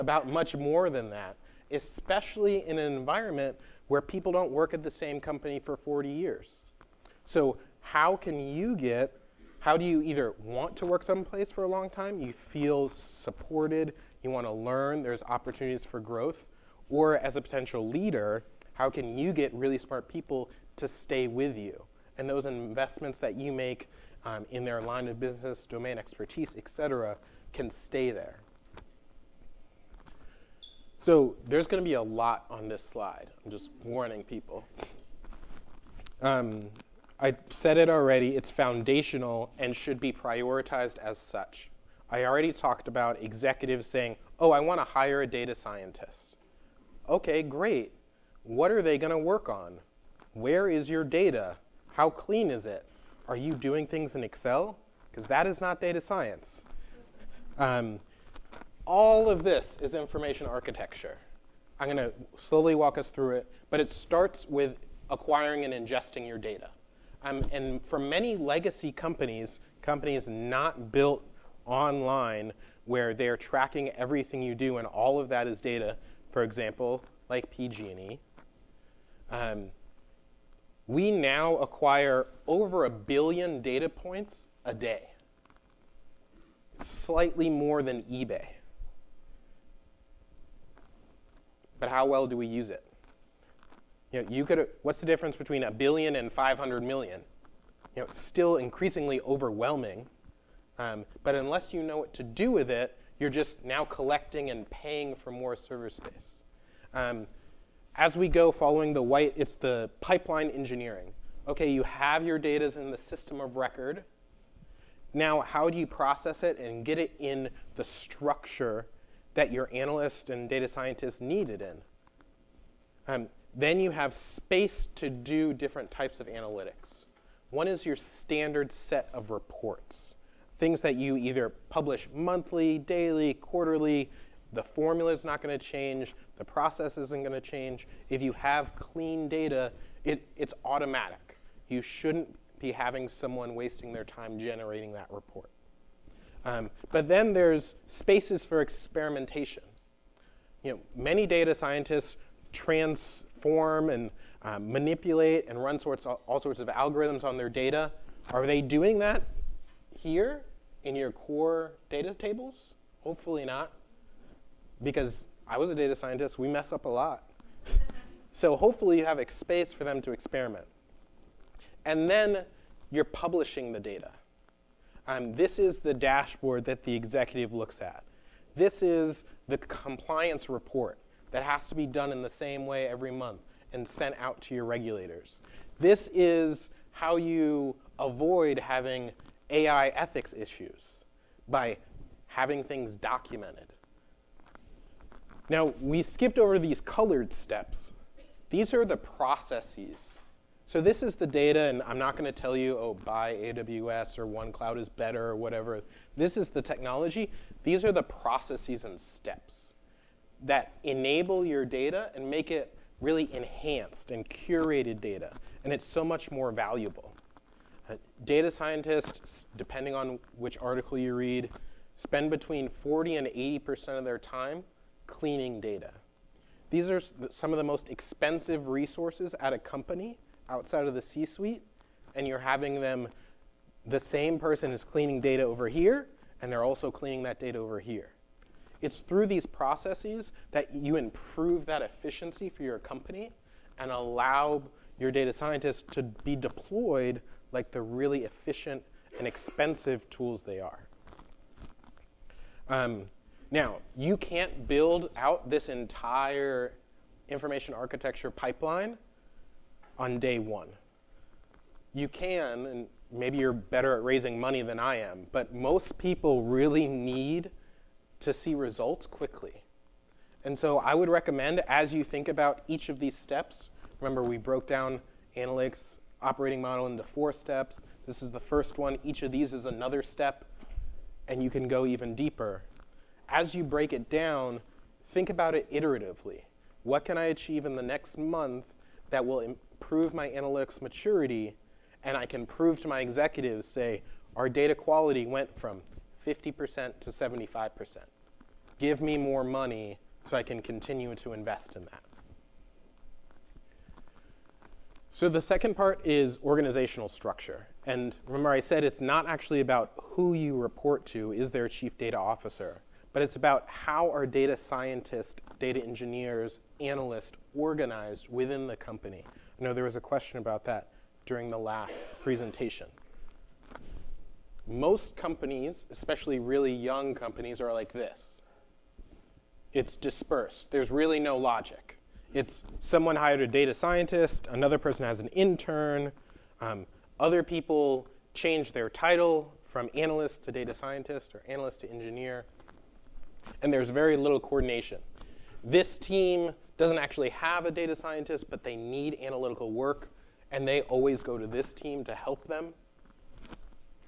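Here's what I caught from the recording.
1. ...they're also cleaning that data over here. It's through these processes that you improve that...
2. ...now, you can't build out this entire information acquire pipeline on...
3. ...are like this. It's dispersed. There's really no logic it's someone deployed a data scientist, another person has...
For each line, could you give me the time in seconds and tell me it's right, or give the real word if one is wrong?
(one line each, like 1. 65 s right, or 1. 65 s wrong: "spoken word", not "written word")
1. 236 s right
2. 253 s wrong: "architecture", not "acquire"
3. 327 s wrong: "hired", not "deployed".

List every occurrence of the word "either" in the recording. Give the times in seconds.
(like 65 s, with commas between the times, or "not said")
10 s, 131 s.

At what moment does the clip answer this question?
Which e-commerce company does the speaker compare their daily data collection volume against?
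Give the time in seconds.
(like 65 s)
88 s.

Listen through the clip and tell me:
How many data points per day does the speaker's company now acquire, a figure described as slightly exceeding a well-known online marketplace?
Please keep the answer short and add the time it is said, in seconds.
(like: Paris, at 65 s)
over 1 billion, at 82 s.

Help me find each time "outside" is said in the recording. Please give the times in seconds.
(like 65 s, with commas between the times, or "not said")
230 s.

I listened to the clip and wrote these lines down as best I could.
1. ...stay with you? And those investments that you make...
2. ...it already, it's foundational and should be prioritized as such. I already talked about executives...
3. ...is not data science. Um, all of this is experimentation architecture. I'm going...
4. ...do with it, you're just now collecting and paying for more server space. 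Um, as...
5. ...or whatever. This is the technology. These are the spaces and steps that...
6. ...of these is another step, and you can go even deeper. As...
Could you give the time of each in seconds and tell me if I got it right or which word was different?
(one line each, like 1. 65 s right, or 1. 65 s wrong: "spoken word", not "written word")
1. 20 s right
2. 37 s right
3. 55 s wrong: "information", not "experimentation"
4. 102 s right
5. 205 s wrong: "processes", not "spaces"
6. 279 s right.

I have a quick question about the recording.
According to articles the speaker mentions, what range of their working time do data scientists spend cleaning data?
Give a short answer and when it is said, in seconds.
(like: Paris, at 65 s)
40 to 80%, at 222 s.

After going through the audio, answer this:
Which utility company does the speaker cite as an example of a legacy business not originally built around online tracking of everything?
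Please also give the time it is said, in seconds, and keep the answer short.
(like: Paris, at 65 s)
PG&E, at 77 s.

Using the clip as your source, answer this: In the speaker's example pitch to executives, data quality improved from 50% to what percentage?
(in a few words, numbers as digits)
75%.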